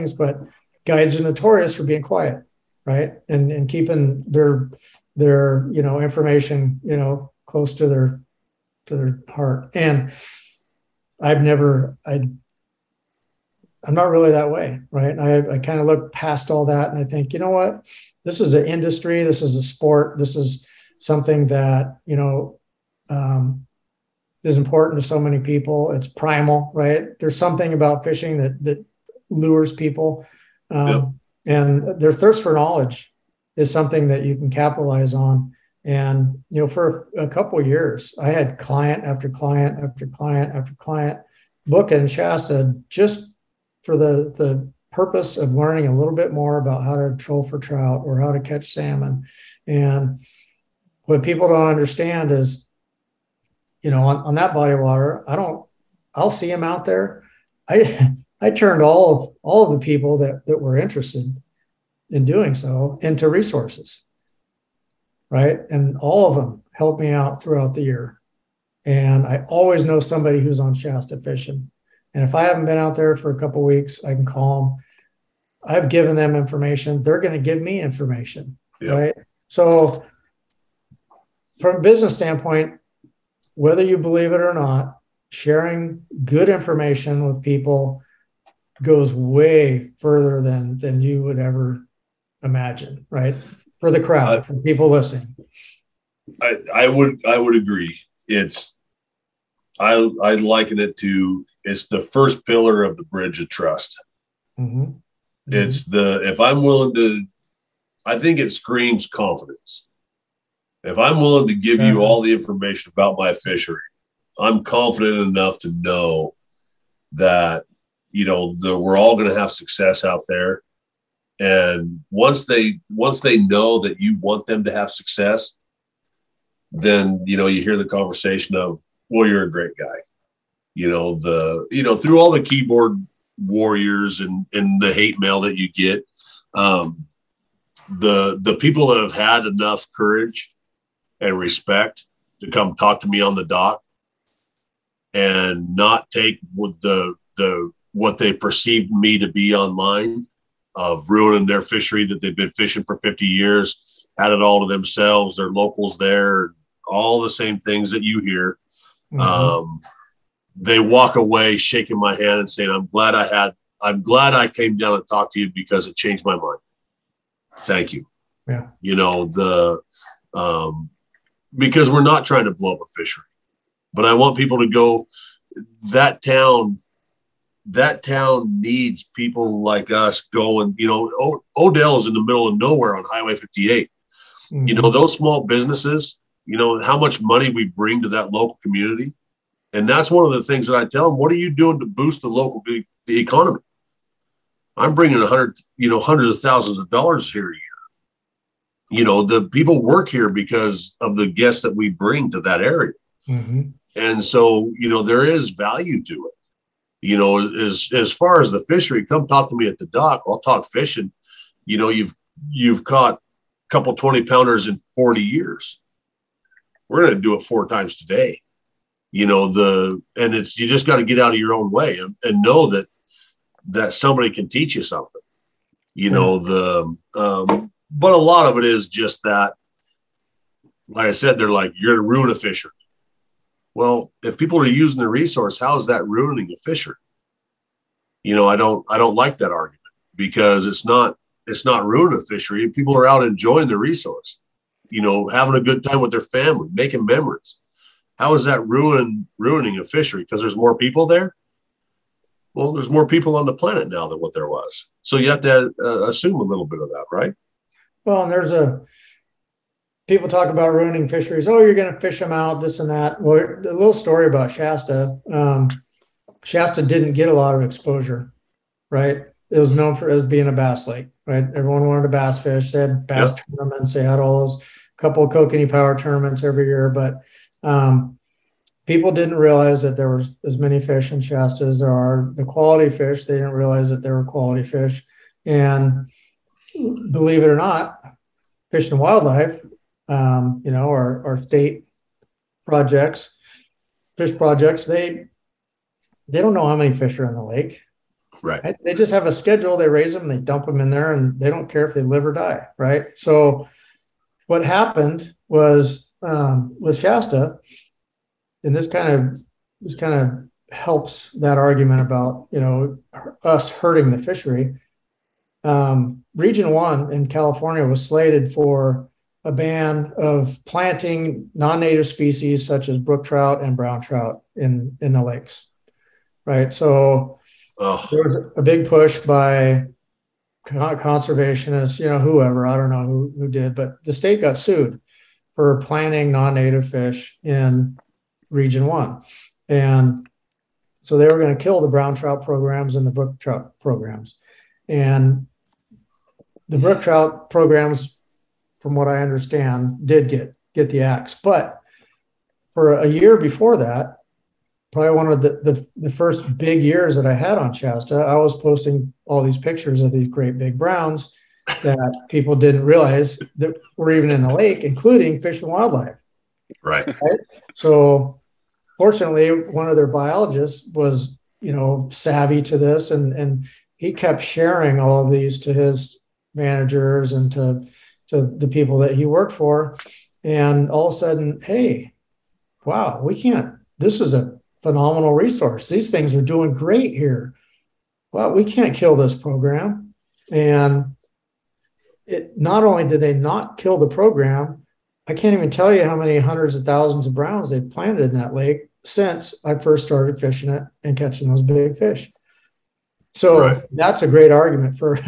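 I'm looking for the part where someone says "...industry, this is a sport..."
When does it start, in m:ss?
0:18.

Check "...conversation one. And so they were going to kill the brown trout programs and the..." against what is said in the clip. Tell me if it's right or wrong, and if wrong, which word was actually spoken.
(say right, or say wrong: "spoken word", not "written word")
wrong: "region", not "conversation".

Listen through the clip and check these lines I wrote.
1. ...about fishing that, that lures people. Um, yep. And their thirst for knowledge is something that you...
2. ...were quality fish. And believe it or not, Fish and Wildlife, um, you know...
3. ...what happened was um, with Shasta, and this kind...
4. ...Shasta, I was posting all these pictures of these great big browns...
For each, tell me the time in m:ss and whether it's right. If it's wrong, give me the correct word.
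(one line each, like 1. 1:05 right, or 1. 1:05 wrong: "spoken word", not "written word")
1. 0:27 right
2. 4:44 right
3. 5:04 right
4. 5:57 right.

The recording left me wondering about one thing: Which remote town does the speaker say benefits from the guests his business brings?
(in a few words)
Odell.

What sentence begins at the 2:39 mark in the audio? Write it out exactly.
um, they walk away shaking my hand and saying, "I'm glad I had.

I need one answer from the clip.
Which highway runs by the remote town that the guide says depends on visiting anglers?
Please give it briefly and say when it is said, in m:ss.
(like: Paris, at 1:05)
Highway 58, at 3:03.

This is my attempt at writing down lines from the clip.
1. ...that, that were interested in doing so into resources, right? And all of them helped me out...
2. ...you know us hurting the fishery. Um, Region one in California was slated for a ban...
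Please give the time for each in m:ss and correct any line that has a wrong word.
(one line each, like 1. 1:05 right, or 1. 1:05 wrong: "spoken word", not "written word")
1. 1:00 right
2. 5:12 right.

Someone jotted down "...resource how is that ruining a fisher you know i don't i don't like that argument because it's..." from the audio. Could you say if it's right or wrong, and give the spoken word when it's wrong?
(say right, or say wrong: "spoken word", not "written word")
right.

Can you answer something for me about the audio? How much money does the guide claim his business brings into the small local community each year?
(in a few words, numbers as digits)
hundreds of thousands of dollars.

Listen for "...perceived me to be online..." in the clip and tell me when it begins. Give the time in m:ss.
2:28.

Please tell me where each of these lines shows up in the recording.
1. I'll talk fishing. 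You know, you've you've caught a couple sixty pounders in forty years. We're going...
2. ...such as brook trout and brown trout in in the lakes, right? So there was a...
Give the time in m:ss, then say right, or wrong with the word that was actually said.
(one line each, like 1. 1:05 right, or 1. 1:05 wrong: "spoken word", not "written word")
1. 3:30 wrong: "twenty", not "sixty"
2. 5:22 right.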